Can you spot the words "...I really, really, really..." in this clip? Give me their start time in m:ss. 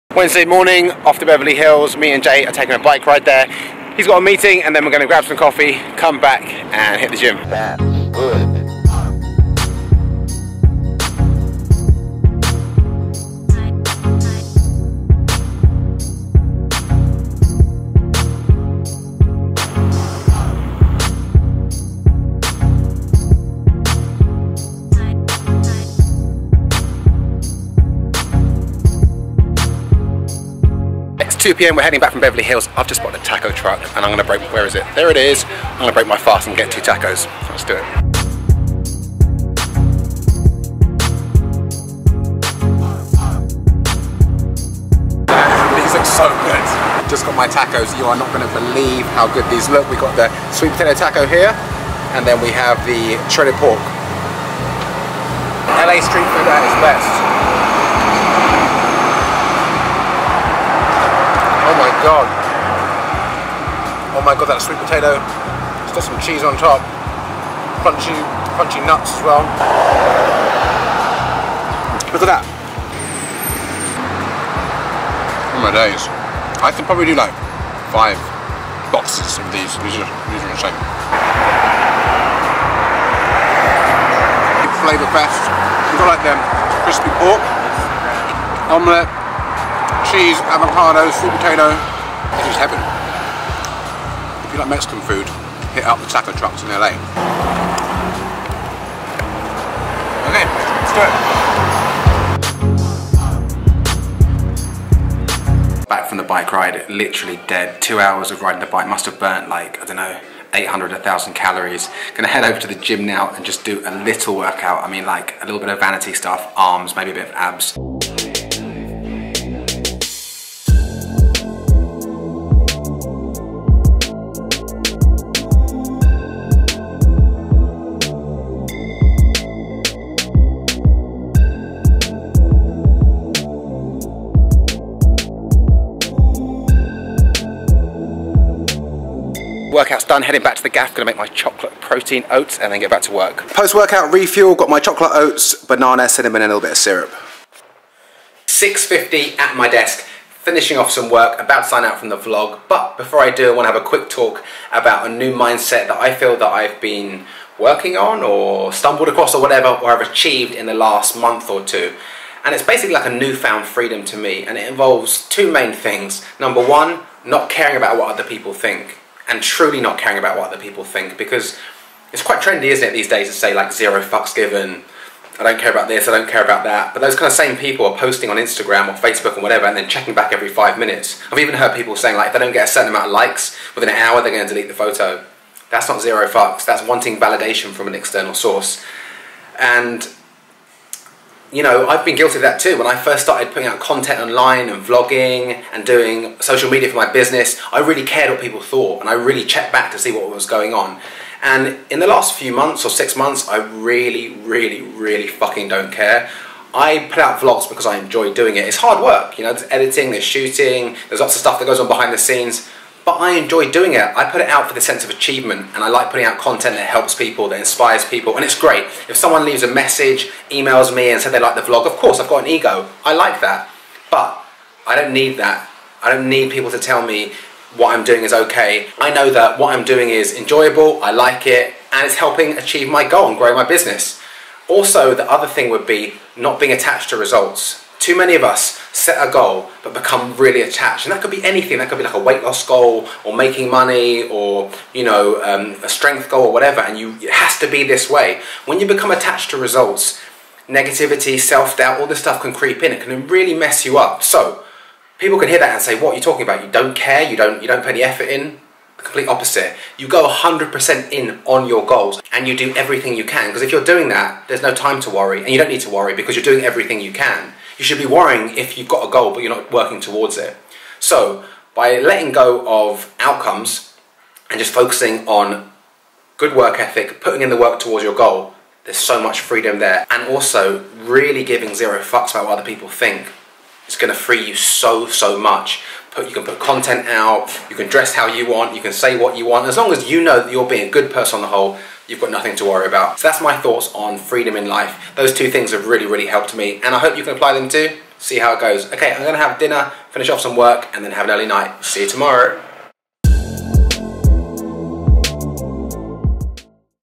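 3:23.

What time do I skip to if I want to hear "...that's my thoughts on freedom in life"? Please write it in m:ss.
4:53.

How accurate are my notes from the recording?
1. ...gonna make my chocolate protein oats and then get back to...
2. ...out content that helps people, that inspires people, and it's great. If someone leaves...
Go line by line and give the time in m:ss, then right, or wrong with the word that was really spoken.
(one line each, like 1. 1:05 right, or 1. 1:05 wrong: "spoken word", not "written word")
1. 2:20 right
2. 3:36 right.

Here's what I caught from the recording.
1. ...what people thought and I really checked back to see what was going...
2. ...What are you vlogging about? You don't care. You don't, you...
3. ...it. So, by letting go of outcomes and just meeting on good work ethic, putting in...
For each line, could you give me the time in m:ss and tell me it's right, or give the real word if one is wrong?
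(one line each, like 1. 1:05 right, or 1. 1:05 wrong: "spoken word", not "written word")
1. 3:18 right
2. 4:15 wrong: "talking", not "vlogging"
3. 4:30 wrong: "focusing", not "meeting".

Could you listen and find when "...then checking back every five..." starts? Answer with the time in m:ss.
2:59.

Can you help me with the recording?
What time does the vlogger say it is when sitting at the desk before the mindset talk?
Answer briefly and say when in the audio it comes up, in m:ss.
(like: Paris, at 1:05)
6:50, at 2:28.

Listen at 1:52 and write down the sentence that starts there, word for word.
Gonna head over to the gym now and just do a little workout.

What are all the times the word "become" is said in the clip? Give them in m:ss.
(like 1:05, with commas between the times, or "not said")
3:59, 4:08.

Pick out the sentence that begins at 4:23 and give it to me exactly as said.
Because if you're doing that, there's no time to worry and you don't need to worry because you're doing everything you can.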